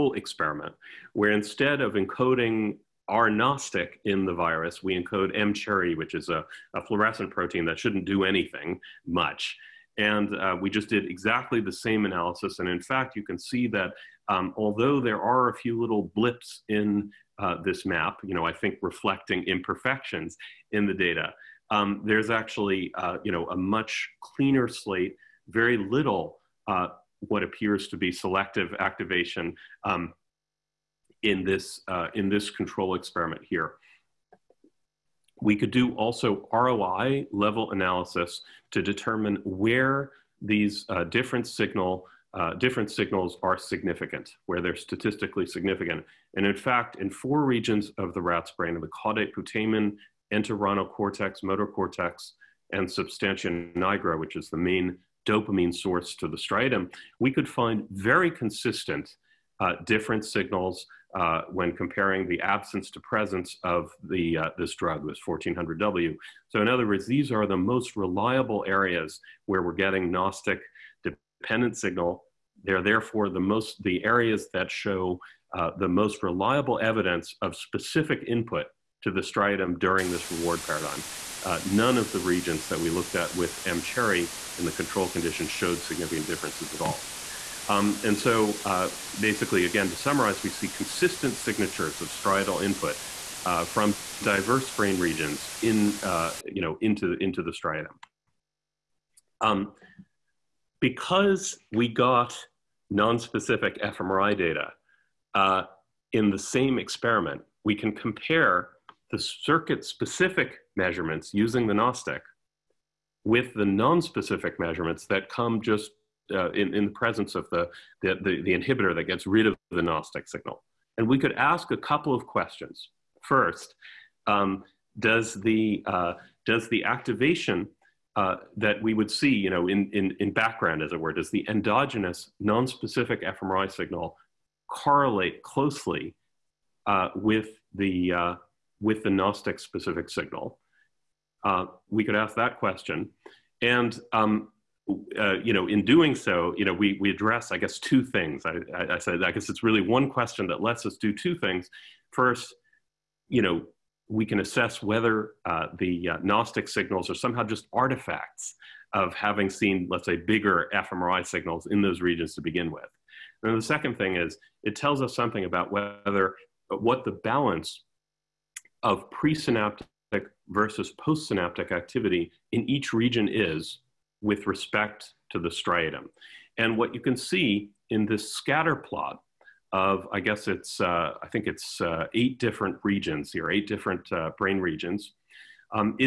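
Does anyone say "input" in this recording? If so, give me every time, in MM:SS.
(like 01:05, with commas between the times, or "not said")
01:18, 01:32.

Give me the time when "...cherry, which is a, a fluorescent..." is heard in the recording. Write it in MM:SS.
00:05.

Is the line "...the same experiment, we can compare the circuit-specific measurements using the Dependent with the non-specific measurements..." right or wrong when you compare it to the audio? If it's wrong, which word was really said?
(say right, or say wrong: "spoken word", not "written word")
wrong: "Gnostic", not "Dependent".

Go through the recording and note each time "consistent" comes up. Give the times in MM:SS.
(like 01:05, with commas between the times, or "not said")
00:58, 01:30.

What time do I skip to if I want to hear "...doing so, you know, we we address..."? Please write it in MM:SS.
02:25.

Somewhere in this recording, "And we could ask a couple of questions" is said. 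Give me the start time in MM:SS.
02:00.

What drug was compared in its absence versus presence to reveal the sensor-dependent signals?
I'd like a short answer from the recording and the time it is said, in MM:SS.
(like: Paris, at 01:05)
1400W, at 01:05.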